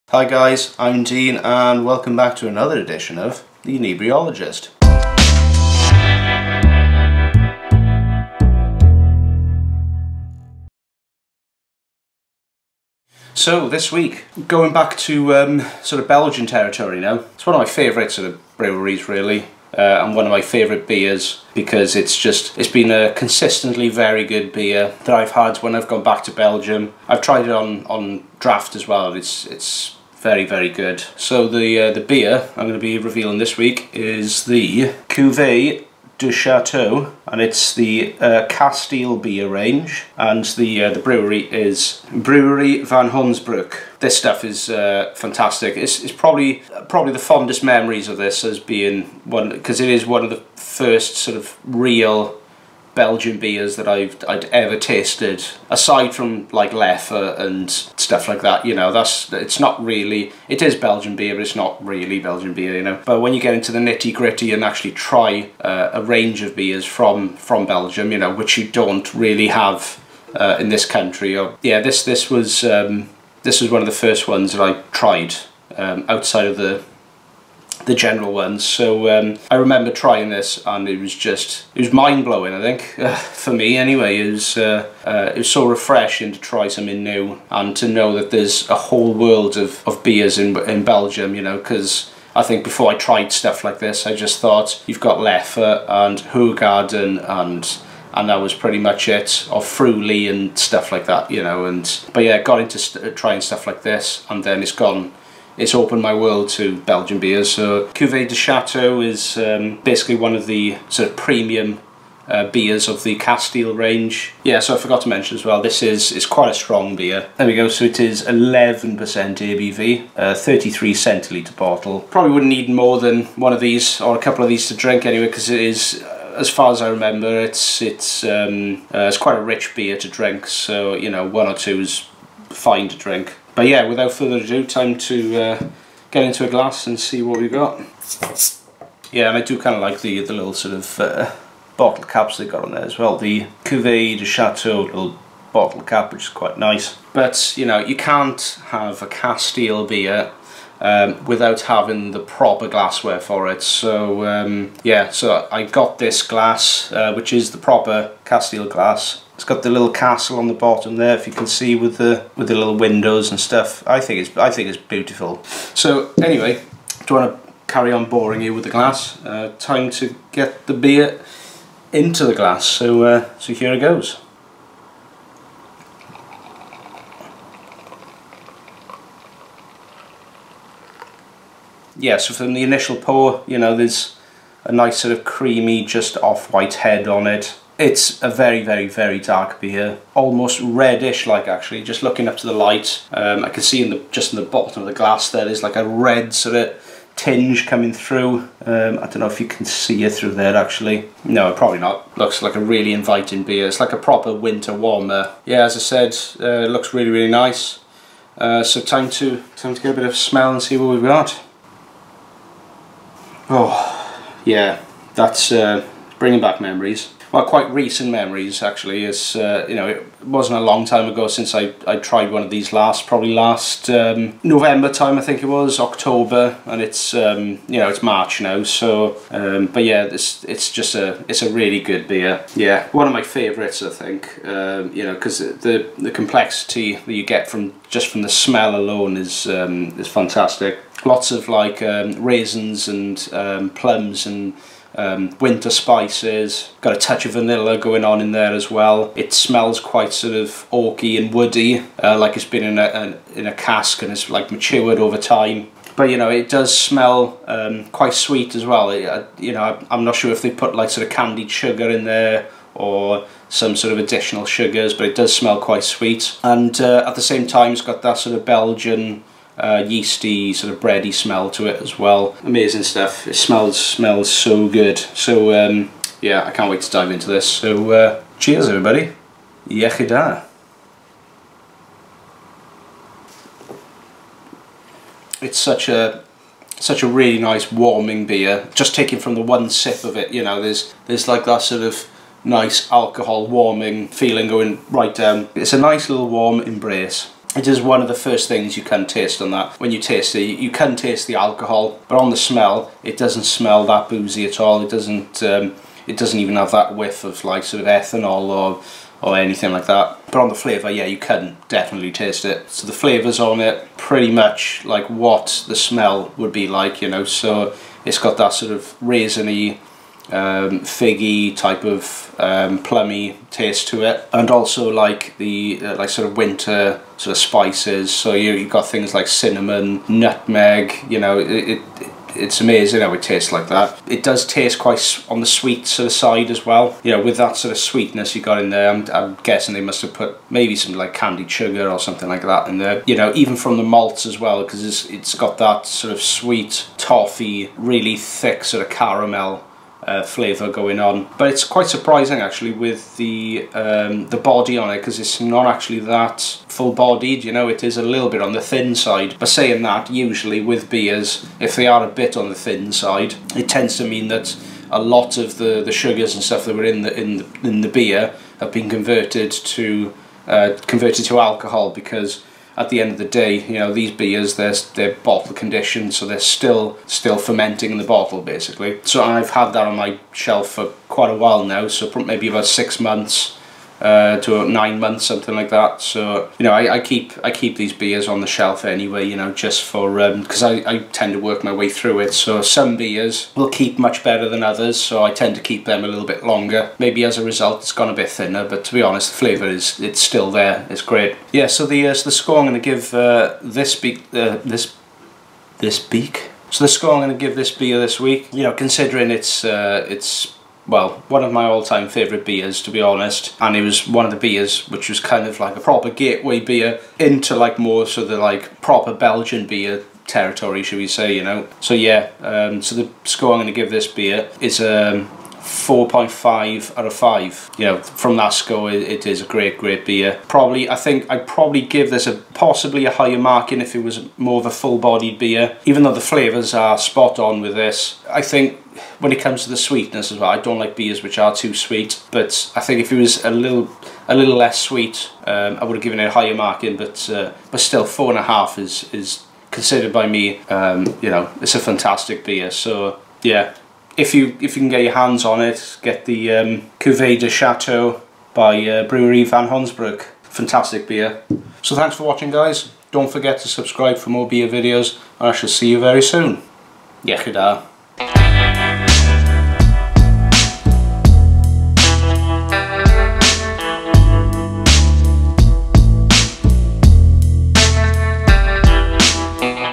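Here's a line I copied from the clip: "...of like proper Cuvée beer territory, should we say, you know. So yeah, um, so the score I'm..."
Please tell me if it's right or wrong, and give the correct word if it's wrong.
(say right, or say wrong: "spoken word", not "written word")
wrong: "Belgian", not "Cuvée".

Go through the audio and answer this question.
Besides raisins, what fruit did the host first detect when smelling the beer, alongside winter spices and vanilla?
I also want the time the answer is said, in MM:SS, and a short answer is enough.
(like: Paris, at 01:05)
plums, at 04:03.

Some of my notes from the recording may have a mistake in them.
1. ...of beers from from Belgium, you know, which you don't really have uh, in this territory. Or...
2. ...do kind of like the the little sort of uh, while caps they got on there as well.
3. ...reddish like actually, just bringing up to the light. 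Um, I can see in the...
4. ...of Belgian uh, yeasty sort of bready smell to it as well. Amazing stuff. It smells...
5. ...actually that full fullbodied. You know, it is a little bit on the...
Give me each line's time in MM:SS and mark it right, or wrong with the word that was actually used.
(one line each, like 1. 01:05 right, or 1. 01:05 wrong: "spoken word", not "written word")
1. 01:06 wrong: "country", not "territory"
2. 02:19 wrong: "bottle", not "while"
3. 03:10 wrong: "looking", not "bringing"
4. 04:28 right
5. 05:55 wrong: "bodied", not "fullbodied".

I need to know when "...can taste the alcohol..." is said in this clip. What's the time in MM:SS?
05:00.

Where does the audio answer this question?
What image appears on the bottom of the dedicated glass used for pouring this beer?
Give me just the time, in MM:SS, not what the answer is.
02:39.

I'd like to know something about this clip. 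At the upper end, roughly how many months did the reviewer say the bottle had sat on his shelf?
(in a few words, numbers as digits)
9 months.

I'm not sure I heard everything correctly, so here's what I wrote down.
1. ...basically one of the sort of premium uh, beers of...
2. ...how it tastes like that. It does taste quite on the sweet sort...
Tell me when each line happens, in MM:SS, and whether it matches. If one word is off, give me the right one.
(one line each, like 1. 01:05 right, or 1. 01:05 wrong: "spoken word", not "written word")
1. 01:49 right
2. 05:33 right.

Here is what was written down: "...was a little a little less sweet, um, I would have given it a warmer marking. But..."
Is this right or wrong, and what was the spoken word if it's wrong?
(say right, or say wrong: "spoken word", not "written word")
wrong: "higher", not "warmer".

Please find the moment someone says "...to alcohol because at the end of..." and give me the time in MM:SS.
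06:11.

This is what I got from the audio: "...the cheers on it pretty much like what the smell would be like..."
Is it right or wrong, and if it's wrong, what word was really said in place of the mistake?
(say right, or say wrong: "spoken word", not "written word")
wrong: "flavours", not "cheers".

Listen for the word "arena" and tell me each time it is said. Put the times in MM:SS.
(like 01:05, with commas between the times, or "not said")
not said.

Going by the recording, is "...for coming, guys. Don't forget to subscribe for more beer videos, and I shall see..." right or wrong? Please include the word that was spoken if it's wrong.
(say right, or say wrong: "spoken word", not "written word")
wrong: "watching", not "coming".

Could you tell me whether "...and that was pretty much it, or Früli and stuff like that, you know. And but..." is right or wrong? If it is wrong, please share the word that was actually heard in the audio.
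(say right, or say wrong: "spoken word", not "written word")
right.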